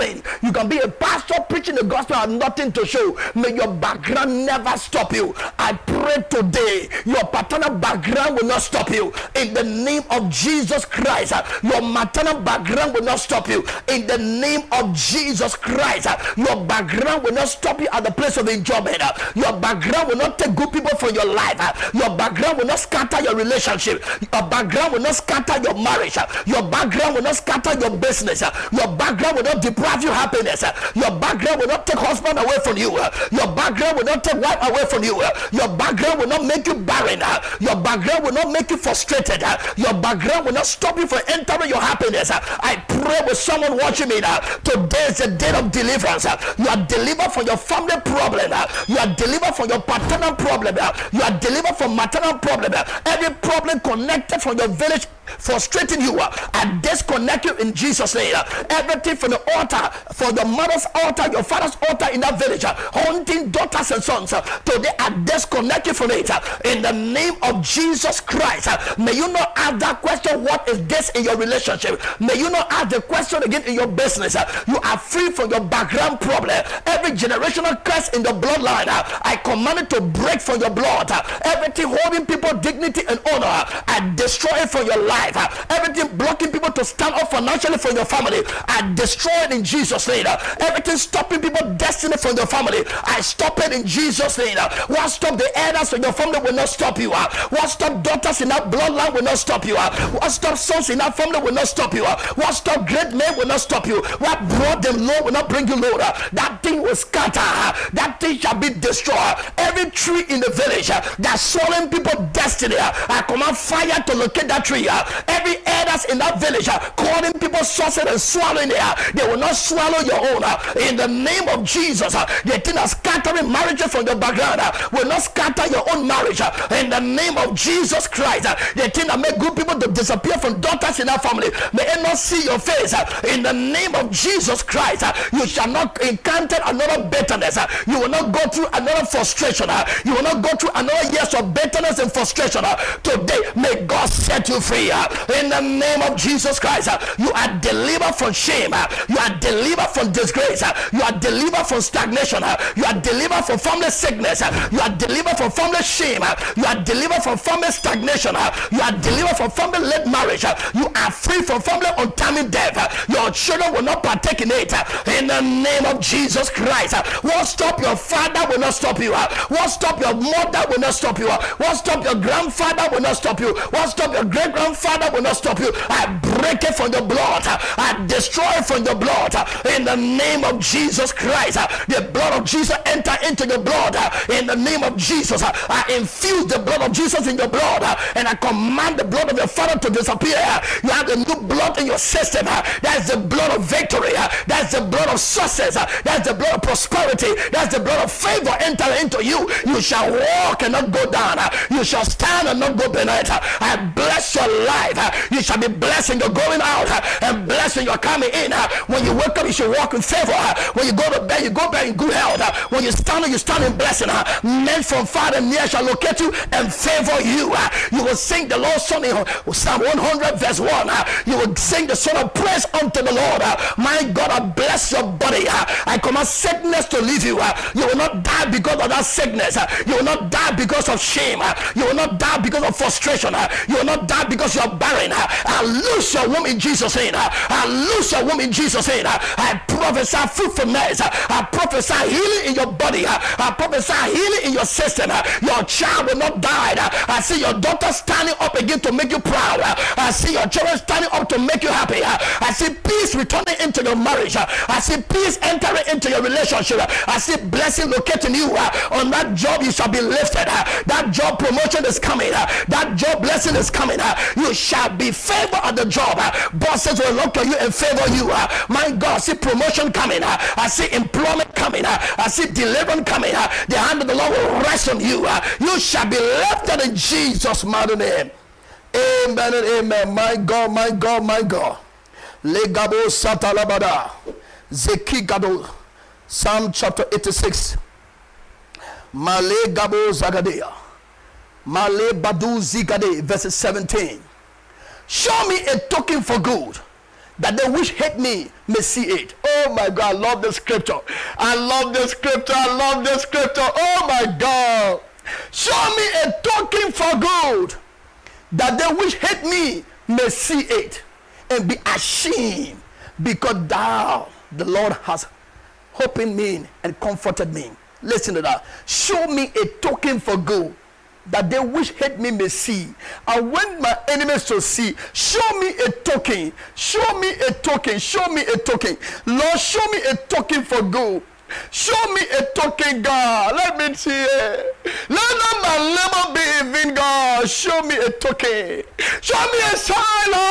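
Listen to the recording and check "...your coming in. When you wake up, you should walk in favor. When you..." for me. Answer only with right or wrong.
right.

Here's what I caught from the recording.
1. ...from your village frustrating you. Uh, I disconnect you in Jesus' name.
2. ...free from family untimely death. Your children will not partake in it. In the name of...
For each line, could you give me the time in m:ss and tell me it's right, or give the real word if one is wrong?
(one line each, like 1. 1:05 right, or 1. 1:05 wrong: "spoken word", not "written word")
1. 0:54 right
2. 2:41 right.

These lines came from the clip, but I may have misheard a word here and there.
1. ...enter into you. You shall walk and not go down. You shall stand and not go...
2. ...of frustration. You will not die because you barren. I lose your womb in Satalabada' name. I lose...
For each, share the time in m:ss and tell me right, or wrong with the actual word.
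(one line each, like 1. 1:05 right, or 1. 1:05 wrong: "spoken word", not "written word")
1. 3:18 right
2. 3:52 wrong: "Jesus", not "Satalabada".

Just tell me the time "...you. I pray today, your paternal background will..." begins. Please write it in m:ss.
0:05.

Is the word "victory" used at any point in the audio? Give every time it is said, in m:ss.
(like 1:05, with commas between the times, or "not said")
3:13.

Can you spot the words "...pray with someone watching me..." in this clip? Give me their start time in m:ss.
0:42.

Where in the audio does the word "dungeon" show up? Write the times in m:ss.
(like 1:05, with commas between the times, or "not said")
not said.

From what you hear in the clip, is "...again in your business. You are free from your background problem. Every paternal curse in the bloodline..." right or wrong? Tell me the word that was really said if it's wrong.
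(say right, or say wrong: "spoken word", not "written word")
wrong: "generational", not "paternal".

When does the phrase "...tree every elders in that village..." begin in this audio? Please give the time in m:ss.
1:54.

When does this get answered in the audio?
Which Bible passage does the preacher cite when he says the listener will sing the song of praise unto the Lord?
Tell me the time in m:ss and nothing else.
3:39.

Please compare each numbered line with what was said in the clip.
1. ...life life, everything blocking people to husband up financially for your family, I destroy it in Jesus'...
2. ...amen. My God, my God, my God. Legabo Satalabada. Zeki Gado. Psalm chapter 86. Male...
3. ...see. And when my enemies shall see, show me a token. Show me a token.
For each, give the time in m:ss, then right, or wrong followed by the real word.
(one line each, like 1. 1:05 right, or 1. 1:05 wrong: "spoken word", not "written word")
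1. 1:25 wrong: "stand", not "husband"
2. 4:39 right
3. 5:22 right.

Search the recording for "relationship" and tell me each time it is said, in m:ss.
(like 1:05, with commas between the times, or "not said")
0:23, 1:11, 4:16.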